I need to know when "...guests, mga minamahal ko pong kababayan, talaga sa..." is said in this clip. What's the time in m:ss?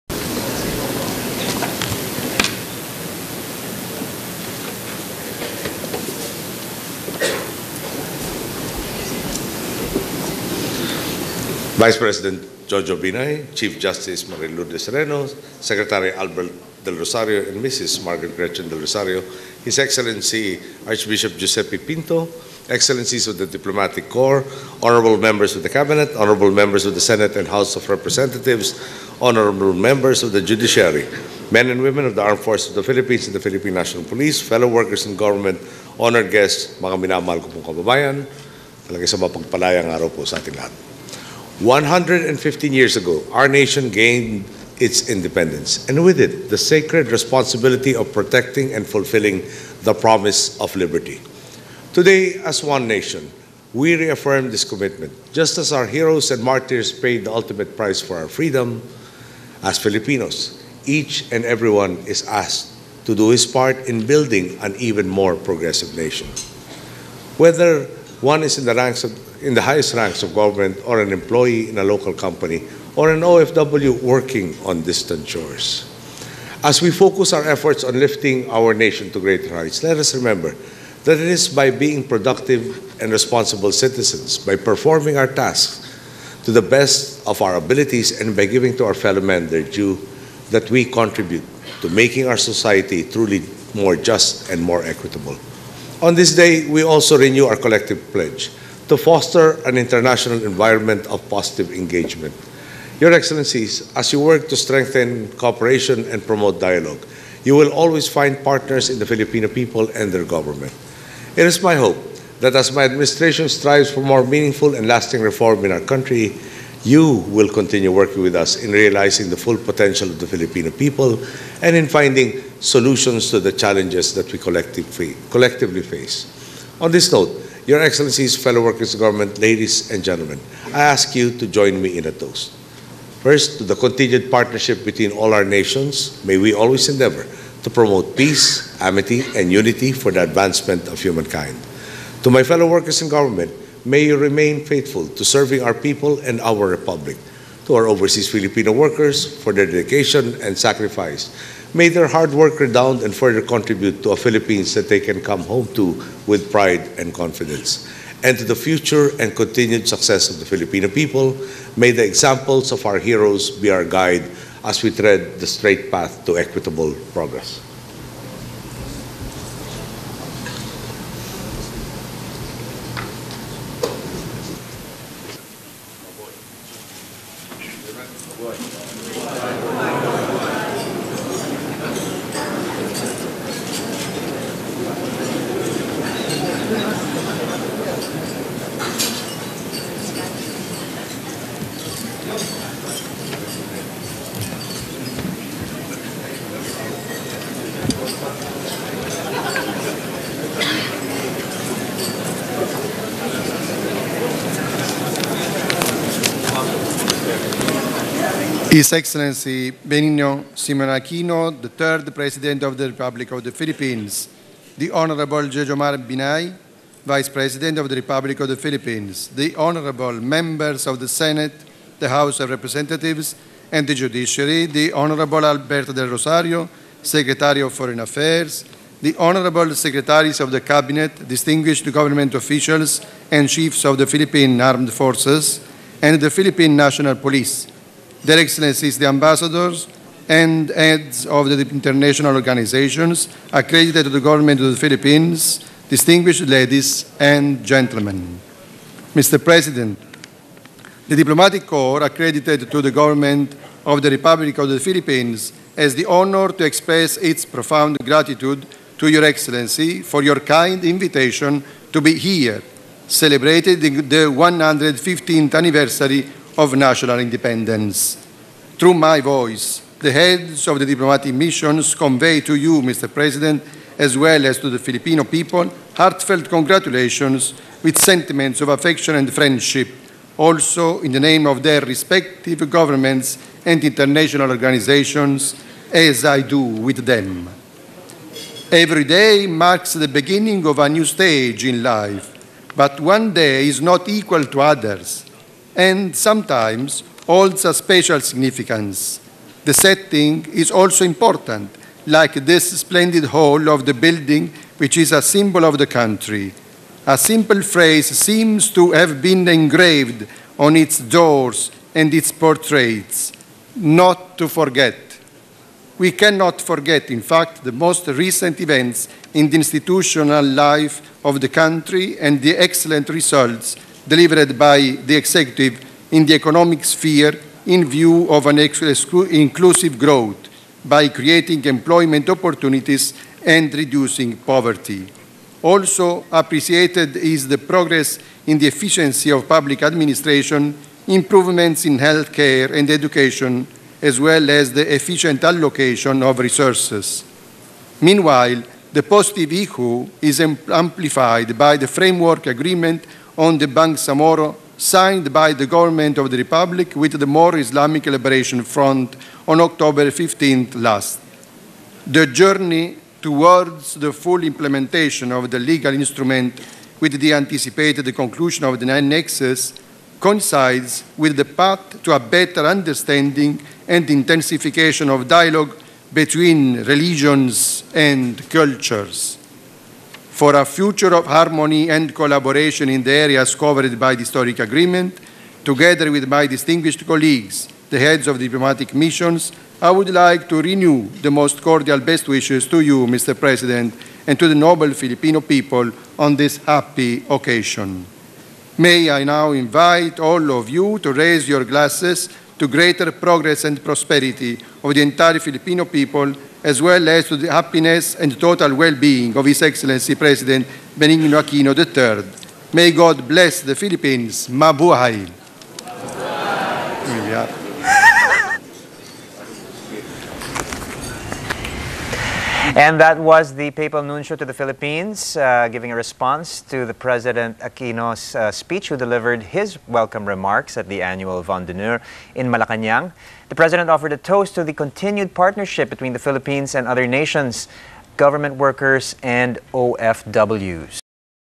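0:36.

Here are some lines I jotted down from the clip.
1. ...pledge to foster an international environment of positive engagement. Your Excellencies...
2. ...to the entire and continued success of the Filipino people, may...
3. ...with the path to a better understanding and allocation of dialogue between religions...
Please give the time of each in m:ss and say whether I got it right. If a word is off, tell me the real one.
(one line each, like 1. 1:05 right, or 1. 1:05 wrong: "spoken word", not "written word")
1. 1:38 right
2. 2:38 wrong: "future", not "entire"
3. 6:11 wrong: "intensification", not "allocation".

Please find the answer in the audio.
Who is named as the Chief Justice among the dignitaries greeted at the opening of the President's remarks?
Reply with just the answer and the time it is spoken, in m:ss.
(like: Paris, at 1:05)
Marie Lourdes Sereno, at 0:14.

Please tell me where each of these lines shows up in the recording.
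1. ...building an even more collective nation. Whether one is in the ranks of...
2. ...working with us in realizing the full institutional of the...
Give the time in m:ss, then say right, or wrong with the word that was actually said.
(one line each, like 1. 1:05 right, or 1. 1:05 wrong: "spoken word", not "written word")
1. 1:04 wrong: "progressive", not "collective"
2. 1:57 wrong: "potential", not "institutional".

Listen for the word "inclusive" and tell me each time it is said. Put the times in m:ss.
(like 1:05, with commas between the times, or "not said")
5:28.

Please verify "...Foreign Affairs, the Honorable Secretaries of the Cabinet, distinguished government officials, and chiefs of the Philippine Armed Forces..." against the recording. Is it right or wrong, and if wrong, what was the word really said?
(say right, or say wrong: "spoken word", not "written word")
right.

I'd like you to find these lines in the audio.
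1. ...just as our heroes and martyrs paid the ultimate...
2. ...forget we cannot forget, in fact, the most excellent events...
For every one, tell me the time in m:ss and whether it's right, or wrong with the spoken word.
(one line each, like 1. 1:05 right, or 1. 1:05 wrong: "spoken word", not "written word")
1. 0:55 right
2. 5:14 wrong: "recent", not "excellent".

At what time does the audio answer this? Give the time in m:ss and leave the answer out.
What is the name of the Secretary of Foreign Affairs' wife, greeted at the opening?
0:18.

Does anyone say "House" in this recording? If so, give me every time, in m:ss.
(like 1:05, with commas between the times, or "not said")
0:27, 3:42.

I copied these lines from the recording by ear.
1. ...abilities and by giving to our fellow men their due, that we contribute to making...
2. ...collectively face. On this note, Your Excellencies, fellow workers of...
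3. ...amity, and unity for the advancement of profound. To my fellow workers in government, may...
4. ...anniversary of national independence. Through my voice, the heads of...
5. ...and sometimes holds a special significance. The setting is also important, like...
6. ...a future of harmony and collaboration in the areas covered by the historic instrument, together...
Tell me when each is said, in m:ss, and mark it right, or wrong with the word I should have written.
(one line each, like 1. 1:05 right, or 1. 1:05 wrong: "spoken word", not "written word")
1. 1:27 right
2. 2:04 right
3. 2:18 wrong: "humankind", not "profound"
4. 4:25 right
5. 4:55 right
6. 6:20 wrong: "agreement", not "instrument".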